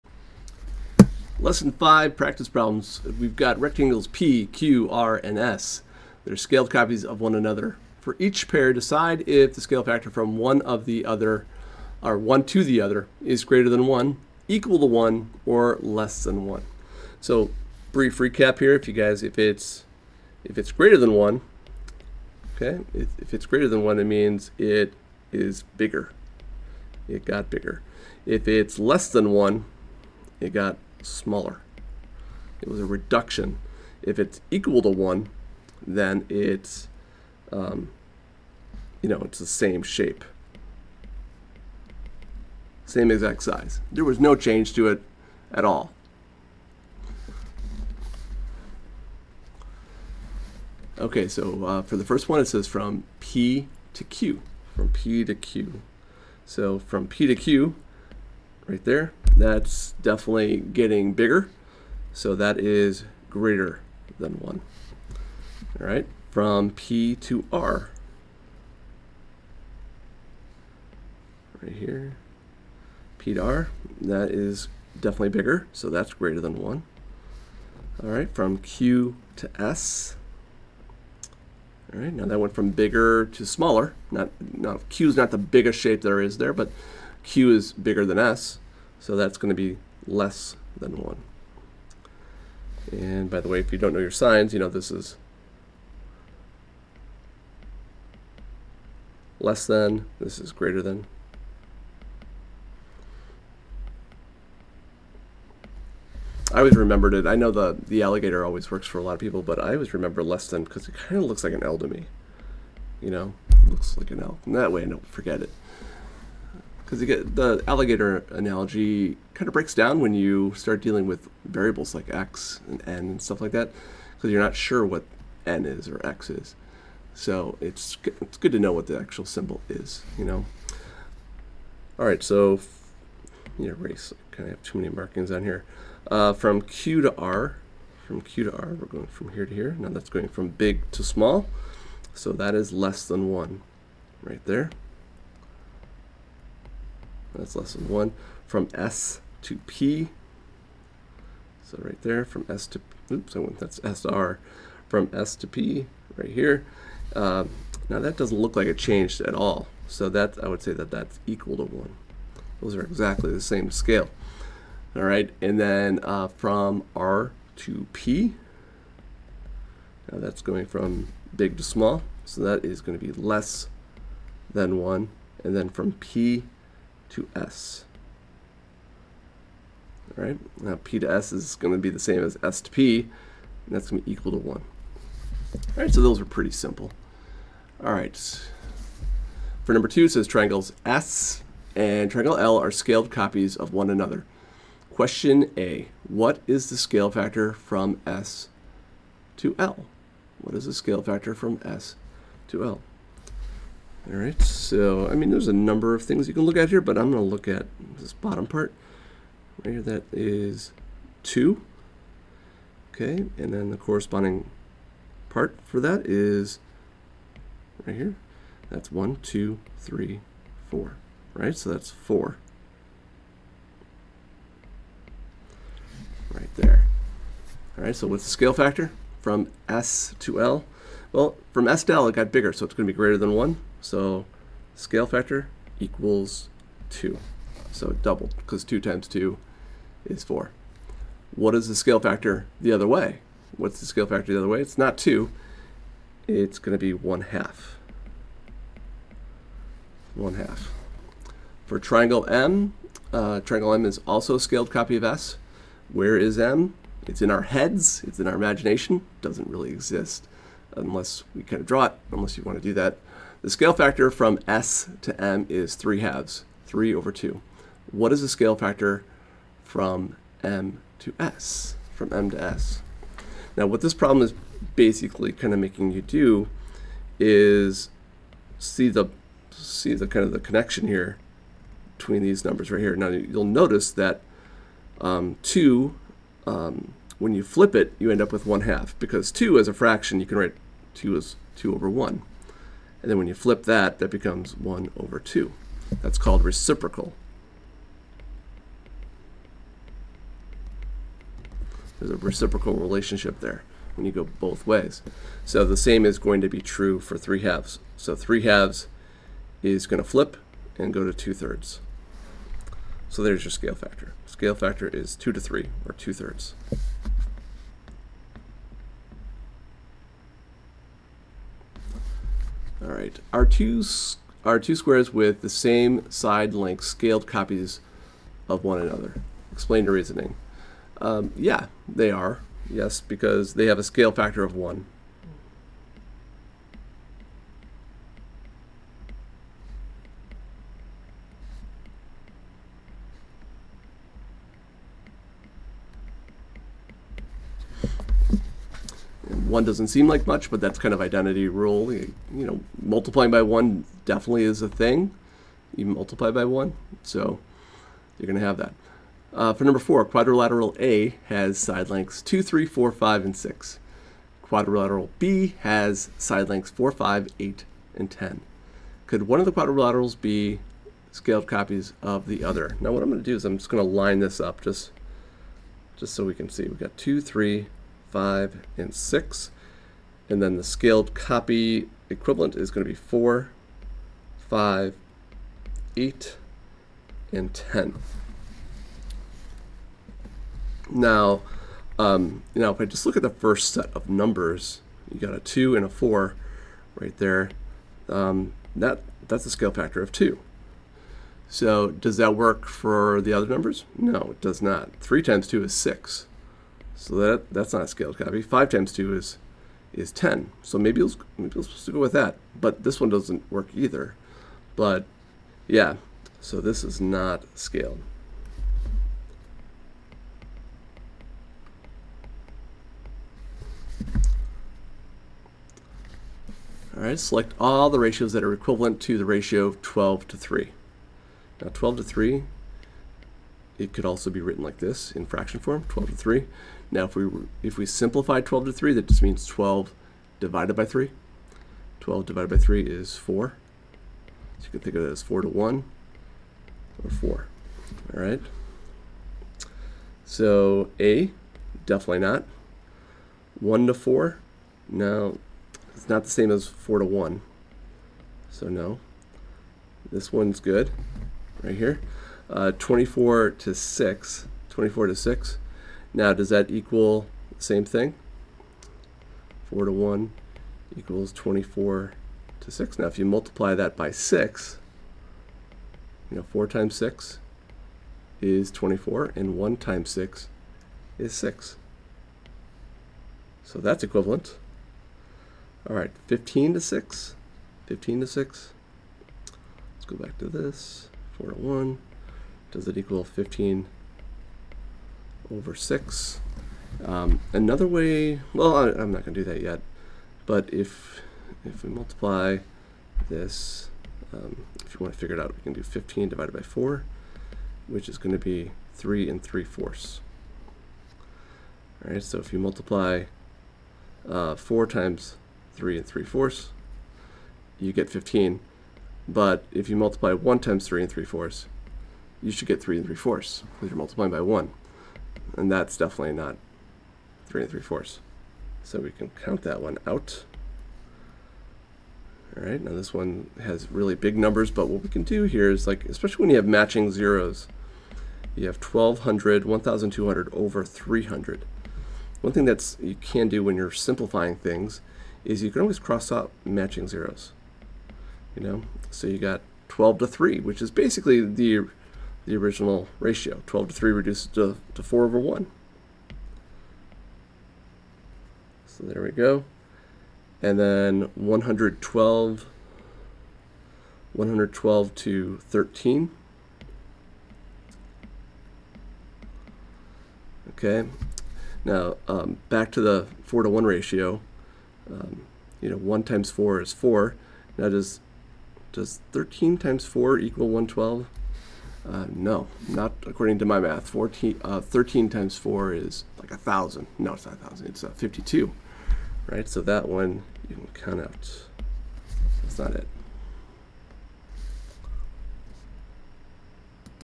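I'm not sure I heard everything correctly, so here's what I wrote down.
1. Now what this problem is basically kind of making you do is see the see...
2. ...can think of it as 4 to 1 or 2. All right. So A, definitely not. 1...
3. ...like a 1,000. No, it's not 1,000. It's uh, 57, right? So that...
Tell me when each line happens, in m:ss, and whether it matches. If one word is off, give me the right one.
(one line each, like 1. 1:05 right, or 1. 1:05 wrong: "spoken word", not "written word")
1. 4:33 right
2. 7:24 wrong: "4", not "2"
3. 9:46 wrong: "52", not "57".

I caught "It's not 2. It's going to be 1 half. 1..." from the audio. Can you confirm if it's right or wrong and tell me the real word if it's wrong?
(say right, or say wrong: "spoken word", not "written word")
right.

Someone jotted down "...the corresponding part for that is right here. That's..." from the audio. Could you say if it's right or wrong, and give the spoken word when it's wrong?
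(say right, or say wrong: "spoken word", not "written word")
right.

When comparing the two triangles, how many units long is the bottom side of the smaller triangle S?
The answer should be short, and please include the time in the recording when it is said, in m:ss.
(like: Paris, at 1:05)
2, at 3:29.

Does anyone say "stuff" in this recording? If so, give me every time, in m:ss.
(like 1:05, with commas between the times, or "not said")
2:03.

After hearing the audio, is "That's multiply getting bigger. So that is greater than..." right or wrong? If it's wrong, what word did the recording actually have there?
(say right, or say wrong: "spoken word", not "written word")
wrong: "definitely", not "multiply".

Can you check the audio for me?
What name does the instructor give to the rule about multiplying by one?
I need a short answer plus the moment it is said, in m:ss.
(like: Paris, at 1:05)
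identity rule, at 5:51.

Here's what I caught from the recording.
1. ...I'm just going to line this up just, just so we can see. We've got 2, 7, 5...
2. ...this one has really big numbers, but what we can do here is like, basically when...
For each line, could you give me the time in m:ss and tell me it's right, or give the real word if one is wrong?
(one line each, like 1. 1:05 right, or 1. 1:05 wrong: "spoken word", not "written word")
1. 6:13 wrong: "3", not "7"
2. 8:52 wrong: "especially", not "basically".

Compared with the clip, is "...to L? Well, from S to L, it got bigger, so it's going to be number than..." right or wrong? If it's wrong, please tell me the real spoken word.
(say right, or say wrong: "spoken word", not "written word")
wrong: "greater", not "number".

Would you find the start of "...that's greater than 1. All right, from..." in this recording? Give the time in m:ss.
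1:15.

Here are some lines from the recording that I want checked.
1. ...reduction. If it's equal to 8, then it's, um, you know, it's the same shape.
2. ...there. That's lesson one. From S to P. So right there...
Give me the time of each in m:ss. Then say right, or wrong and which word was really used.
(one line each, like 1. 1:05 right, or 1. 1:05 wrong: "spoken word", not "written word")
1. 0:32 wrong: "1", not "8"
2. 2:24 right.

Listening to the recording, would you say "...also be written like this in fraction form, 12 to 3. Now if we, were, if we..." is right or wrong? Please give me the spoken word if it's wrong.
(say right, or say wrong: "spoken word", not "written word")
right.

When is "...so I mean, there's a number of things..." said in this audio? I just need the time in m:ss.
3:24.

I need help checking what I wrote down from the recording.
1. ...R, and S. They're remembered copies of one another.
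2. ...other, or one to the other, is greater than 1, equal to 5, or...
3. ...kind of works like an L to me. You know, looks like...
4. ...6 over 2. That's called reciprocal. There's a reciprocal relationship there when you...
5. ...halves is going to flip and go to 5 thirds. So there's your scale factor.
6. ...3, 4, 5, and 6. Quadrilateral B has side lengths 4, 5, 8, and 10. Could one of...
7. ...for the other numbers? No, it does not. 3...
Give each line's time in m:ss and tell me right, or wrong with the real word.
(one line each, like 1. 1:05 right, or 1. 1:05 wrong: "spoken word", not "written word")
1. 0:04 wrong: "scaled", not "remembered"
2. 0:11 wrong: "1", not "5"
3. 1:50 wrong: "looks", not "works"
4. 4:54 wrong: "1", not "6"
5. 5:08 wrong: "2", not "5"
6. 6:02 right
7. 6:42 right.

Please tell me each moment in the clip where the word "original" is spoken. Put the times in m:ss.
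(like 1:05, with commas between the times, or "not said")
9:12.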